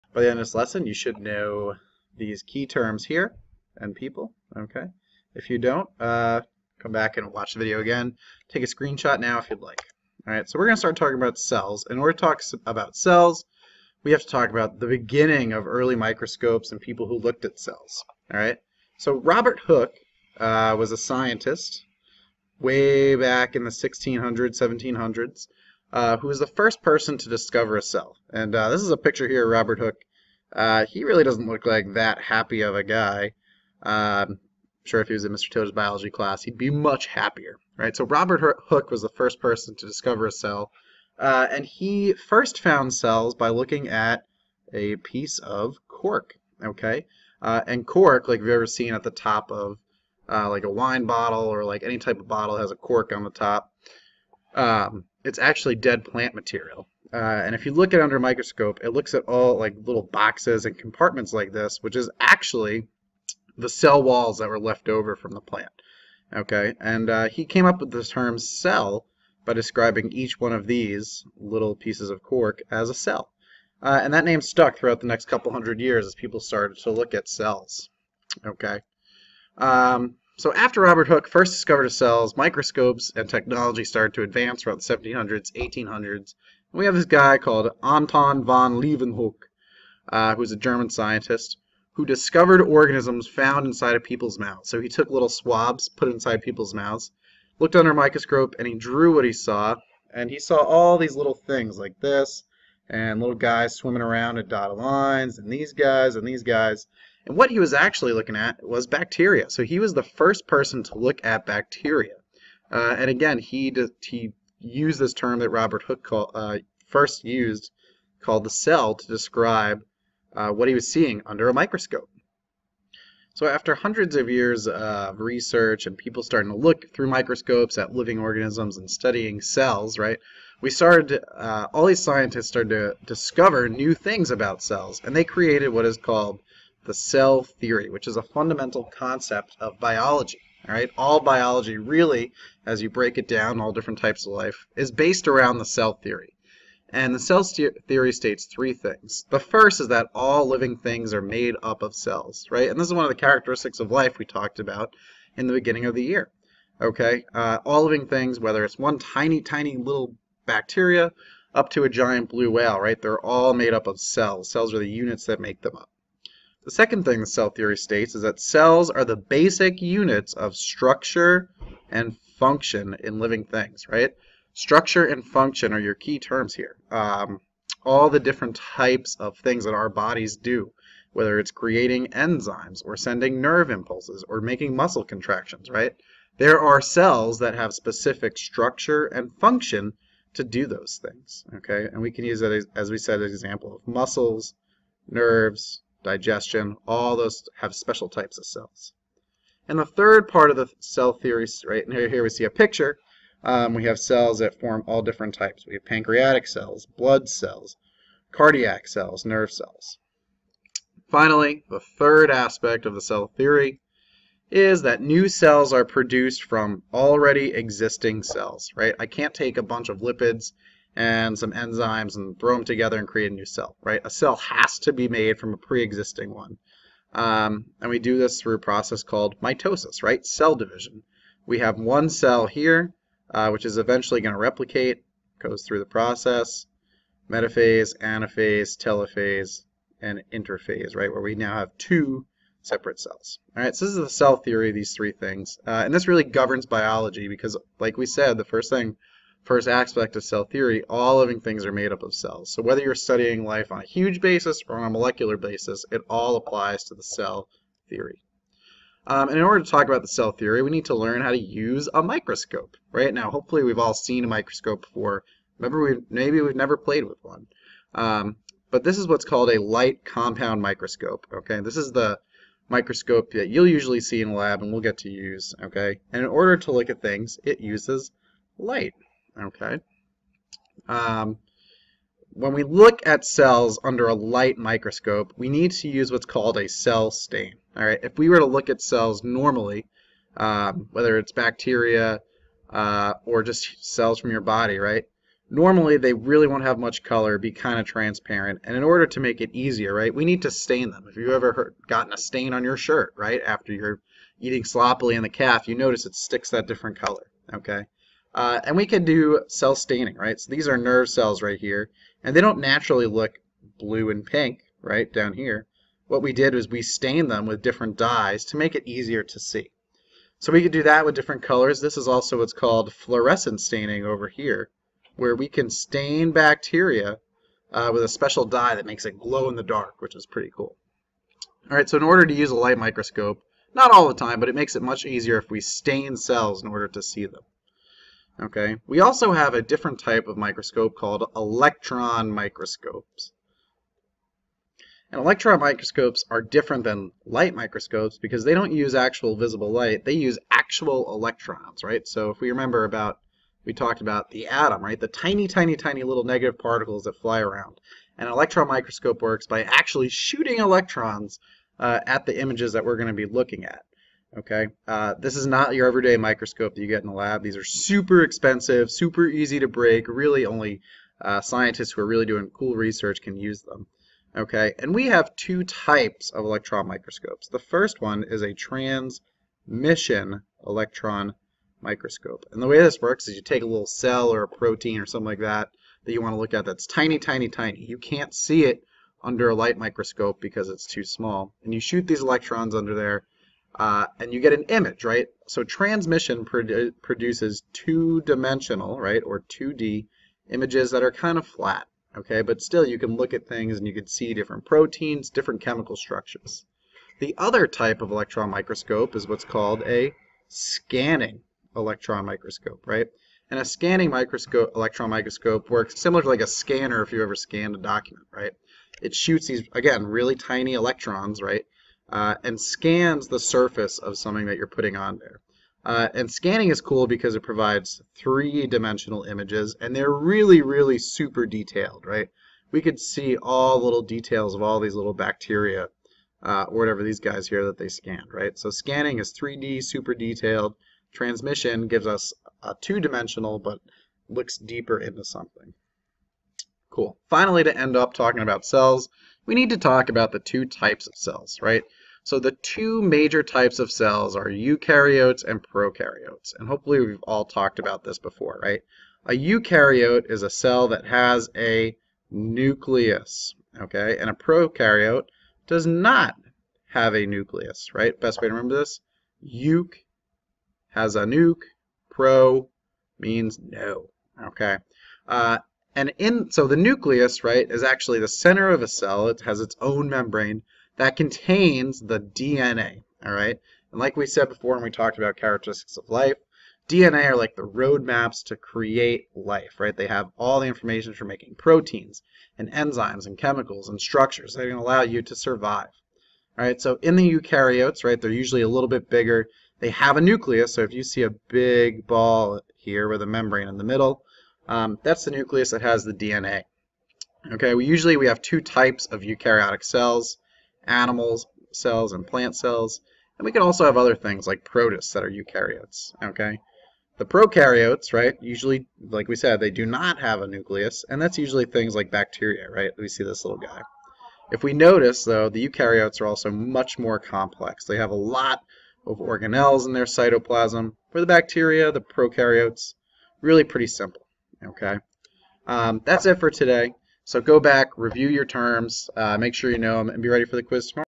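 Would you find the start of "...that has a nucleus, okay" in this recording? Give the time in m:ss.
7:40.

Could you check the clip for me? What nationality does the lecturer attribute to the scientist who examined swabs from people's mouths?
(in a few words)
German.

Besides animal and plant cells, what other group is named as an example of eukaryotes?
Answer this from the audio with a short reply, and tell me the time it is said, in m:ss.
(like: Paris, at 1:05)
Protists, at 8:34.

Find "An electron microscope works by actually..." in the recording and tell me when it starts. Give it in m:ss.
5:58.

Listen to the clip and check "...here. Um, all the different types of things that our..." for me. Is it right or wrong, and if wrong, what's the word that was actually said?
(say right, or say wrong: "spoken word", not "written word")
right.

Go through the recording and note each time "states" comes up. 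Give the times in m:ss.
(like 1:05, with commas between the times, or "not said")
2:28, 2:47.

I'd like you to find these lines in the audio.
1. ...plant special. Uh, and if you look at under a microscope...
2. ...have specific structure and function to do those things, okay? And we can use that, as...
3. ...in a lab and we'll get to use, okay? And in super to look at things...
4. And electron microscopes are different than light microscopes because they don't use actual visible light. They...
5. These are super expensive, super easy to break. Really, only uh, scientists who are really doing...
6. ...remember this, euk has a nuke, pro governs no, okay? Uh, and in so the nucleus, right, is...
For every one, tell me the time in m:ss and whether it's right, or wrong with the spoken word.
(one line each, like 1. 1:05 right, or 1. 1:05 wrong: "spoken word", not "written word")
1. 0:56 wrong: "material", not "special"
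2. 3:07 right
3. 4:34 wrong: "order", not "super"
4. 5:45 right
5. 6:07 right
6. 7:48 wrong: "means", not "governs".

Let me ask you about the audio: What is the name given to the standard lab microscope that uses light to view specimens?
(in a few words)
Light compound microscope.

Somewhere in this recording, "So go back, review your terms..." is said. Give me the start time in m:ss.
8:57.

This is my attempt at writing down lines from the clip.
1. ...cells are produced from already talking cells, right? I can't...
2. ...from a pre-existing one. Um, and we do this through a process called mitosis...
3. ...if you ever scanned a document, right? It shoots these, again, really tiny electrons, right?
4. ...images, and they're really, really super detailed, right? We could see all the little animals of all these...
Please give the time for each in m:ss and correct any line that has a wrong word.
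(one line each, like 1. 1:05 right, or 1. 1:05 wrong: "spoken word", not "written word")
1. 3:35 wrong: "existing", not "talking"
2. 3:45 right
3. 6:57 right
4. 7:09 wrong: "details", not "animals".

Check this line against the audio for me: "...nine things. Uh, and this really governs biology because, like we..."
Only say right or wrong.
wrong.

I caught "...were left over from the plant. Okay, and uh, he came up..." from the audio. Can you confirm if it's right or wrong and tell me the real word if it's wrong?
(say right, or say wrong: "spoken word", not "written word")
right.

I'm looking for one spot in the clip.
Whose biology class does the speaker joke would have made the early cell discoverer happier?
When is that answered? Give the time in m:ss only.
0:35.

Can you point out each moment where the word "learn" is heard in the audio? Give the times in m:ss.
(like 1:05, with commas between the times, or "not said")
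4:20.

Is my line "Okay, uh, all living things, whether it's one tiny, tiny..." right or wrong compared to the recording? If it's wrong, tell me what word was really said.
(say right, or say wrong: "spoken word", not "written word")
right.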